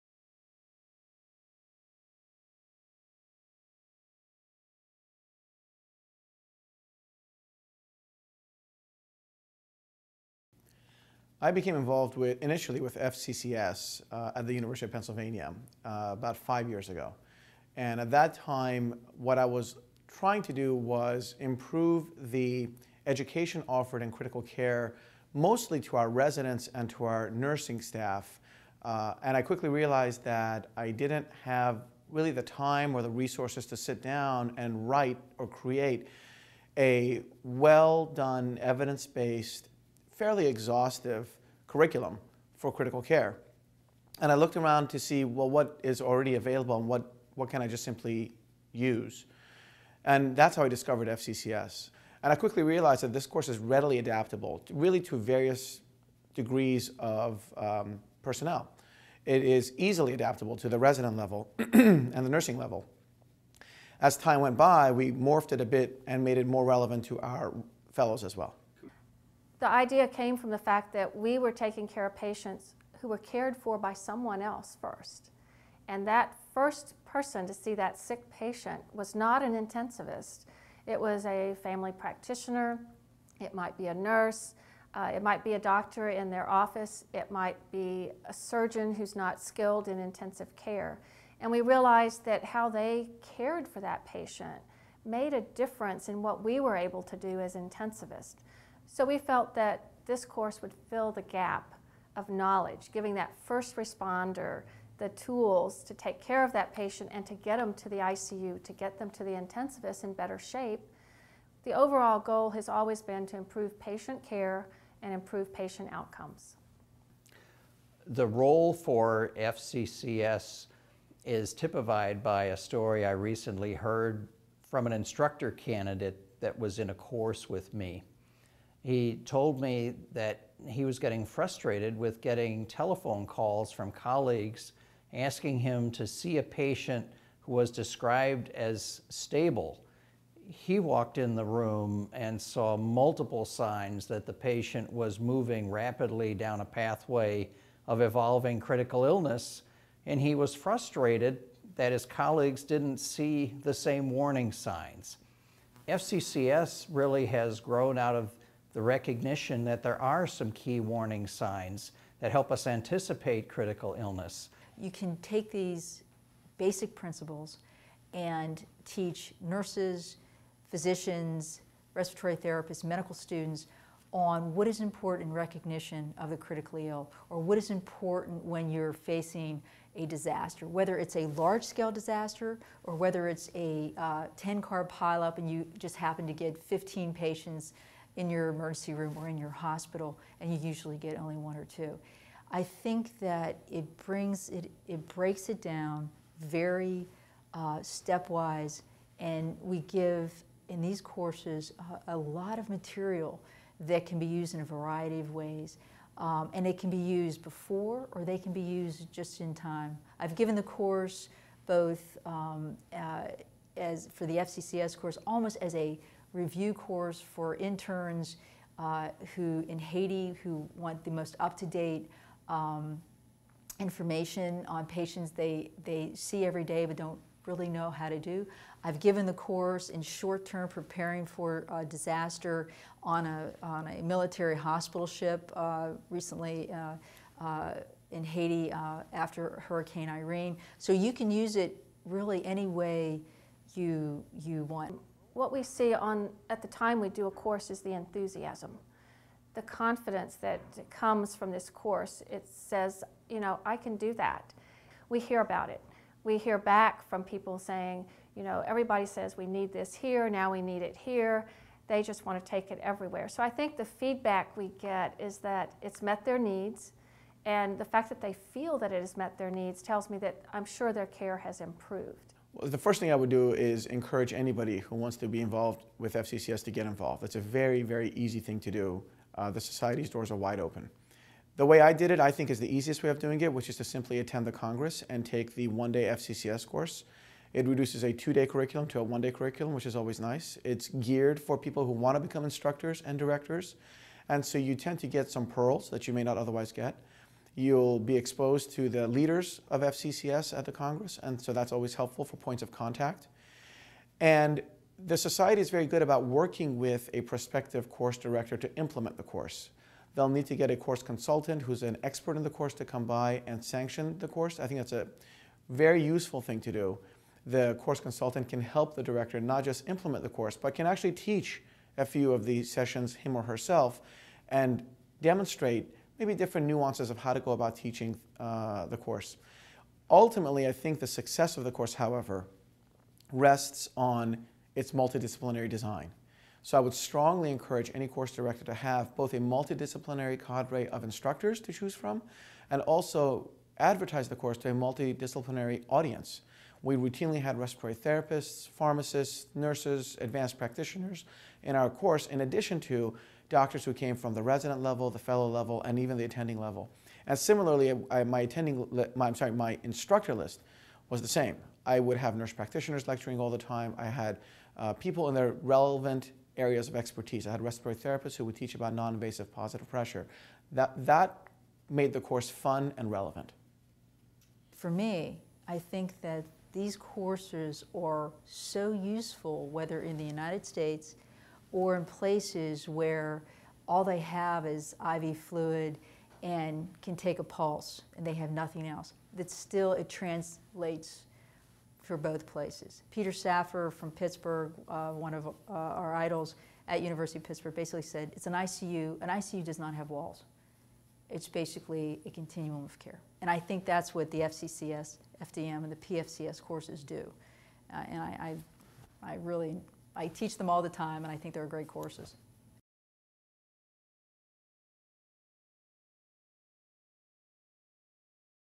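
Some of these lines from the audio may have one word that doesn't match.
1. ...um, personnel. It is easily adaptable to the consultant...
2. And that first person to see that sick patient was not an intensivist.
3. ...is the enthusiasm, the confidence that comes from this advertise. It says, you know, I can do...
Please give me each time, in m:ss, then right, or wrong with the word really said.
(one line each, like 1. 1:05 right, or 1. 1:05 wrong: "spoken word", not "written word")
1. 0:57 wrong: "resident", not "consultant"
2. 1:15 right
3. 4:07 wrong: "course", not "advertise".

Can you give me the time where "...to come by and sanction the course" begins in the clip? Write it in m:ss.
5:12.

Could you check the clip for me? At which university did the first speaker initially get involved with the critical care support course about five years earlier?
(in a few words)
University of Pennsylvania.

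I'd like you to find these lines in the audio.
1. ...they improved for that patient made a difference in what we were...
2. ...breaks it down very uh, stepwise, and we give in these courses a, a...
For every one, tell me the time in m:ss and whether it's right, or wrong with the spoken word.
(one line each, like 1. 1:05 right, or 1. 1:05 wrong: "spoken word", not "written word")
1. 1:32 wrong: "cared", not "improved"
2. 3:15 right.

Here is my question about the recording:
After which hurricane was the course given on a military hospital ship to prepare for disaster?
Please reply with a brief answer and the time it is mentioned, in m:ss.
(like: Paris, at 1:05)
Hurricane Irene, at 3:59.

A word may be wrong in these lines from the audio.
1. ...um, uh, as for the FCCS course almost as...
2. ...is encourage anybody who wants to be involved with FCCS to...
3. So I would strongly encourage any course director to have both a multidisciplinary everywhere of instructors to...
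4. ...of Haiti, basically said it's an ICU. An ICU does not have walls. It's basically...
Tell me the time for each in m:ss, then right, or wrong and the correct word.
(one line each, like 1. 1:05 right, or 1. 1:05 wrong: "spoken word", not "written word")
1. 3:32 right
2. 4:33 right
3. 5:36 wrong: "cadre", not "everywhere"
4. 6:37 wrong: "Pittsburgh", not "Haiti".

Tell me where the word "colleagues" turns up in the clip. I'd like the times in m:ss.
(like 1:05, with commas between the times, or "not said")
2:13, 2:32.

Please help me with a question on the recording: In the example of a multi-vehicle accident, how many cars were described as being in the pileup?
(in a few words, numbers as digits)
10.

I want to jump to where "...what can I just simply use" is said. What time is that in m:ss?
0:47.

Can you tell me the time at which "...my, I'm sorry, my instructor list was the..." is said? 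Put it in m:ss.
5:59.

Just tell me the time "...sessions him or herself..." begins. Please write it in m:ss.
5:22.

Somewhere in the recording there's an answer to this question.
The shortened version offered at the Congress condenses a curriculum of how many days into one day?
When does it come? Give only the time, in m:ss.
4:48.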